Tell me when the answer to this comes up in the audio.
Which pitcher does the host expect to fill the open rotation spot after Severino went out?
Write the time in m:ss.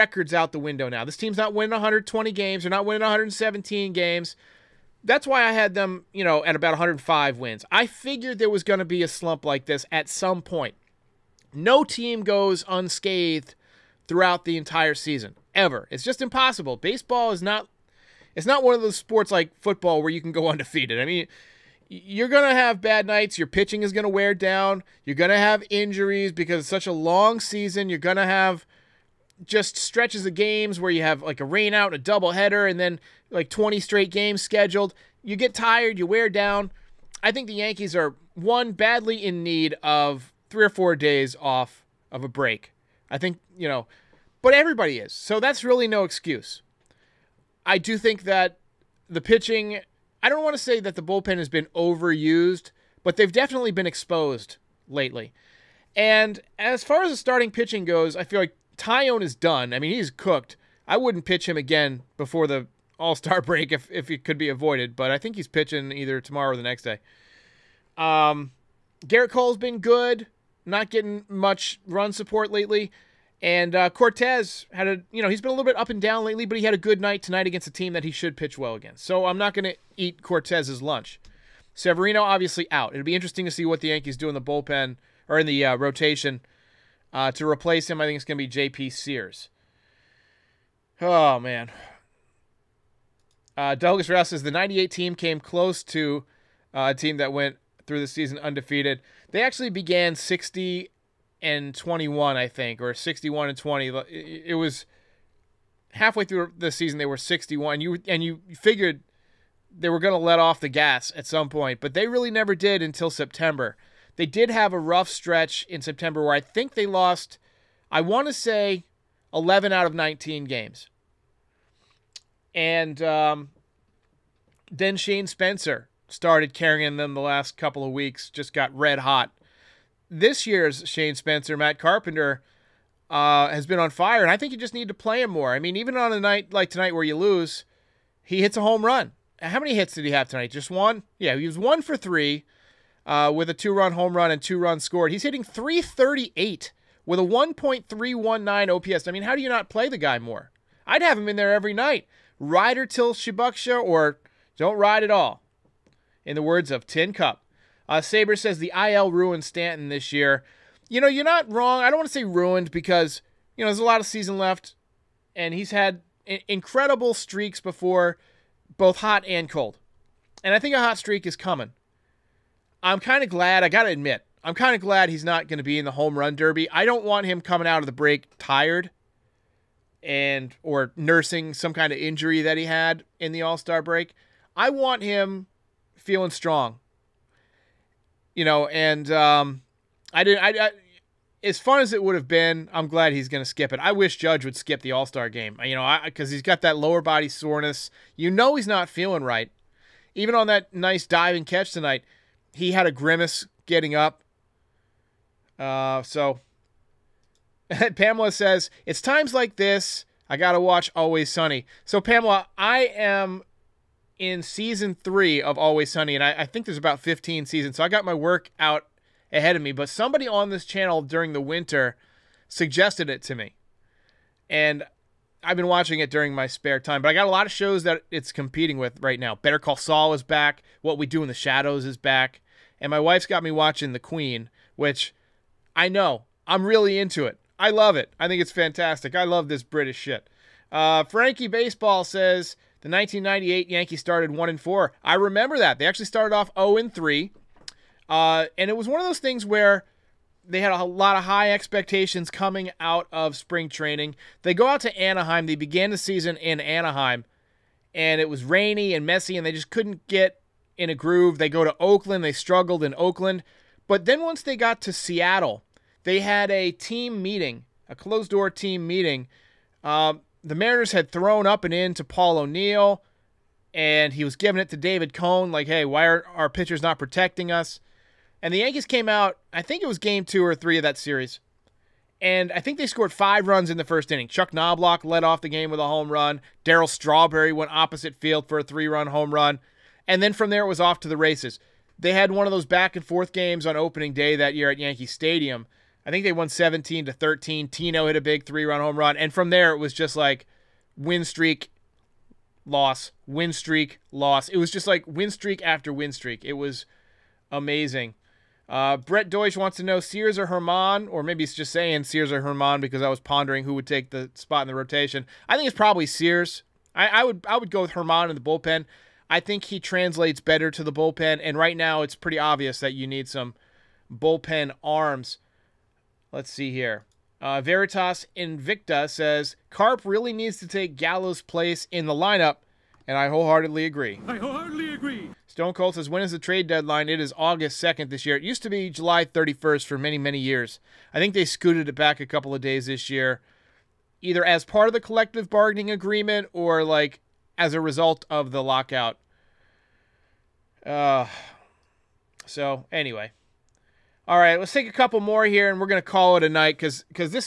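1:28.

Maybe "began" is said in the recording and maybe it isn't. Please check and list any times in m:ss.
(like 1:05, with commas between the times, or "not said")
1:39, 4:15.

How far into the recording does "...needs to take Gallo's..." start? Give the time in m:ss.
5:30.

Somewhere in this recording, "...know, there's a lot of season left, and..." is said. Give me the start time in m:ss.
2:43.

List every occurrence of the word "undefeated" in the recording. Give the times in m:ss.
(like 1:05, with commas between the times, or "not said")
0:20, 1:38.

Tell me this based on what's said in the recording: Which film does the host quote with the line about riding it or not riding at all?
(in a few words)
Tin Cup.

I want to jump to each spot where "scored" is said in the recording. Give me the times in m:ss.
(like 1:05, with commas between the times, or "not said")
2:24, 4:42.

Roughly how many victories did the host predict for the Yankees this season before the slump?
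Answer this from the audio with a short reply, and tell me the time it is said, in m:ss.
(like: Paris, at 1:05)
105, at 0:06.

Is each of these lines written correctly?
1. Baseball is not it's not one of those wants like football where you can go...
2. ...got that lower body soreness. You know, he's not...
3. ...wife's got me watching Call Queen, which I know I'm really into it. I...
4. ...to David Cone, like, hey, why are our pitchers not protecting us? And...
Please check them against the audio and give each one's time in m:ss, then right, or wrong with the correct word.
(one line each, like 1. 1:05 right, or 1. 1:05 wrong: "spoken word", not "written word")
1. 0:16 wrong: "sports", not "wants"
2. 3:16 right
3. 3:52 wrong: "The", not "Call"
4. 4:34 right.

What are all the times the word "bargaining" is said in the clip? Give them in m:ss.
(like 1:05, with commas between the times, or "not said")
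5:45.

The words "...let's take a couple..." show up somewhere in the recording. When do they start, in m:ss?
5:54.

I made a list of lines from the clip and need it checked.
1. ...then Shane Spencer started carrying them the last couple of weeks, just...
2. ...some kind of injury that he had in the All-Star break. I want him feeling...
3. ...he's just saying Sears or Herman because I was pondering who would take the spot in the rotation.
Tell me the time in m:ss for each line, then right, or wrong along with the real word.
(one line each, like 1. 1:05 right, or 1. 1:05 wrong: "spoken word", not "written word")
1. 2:04 right
2. 3:01 right
3. 5:11 right.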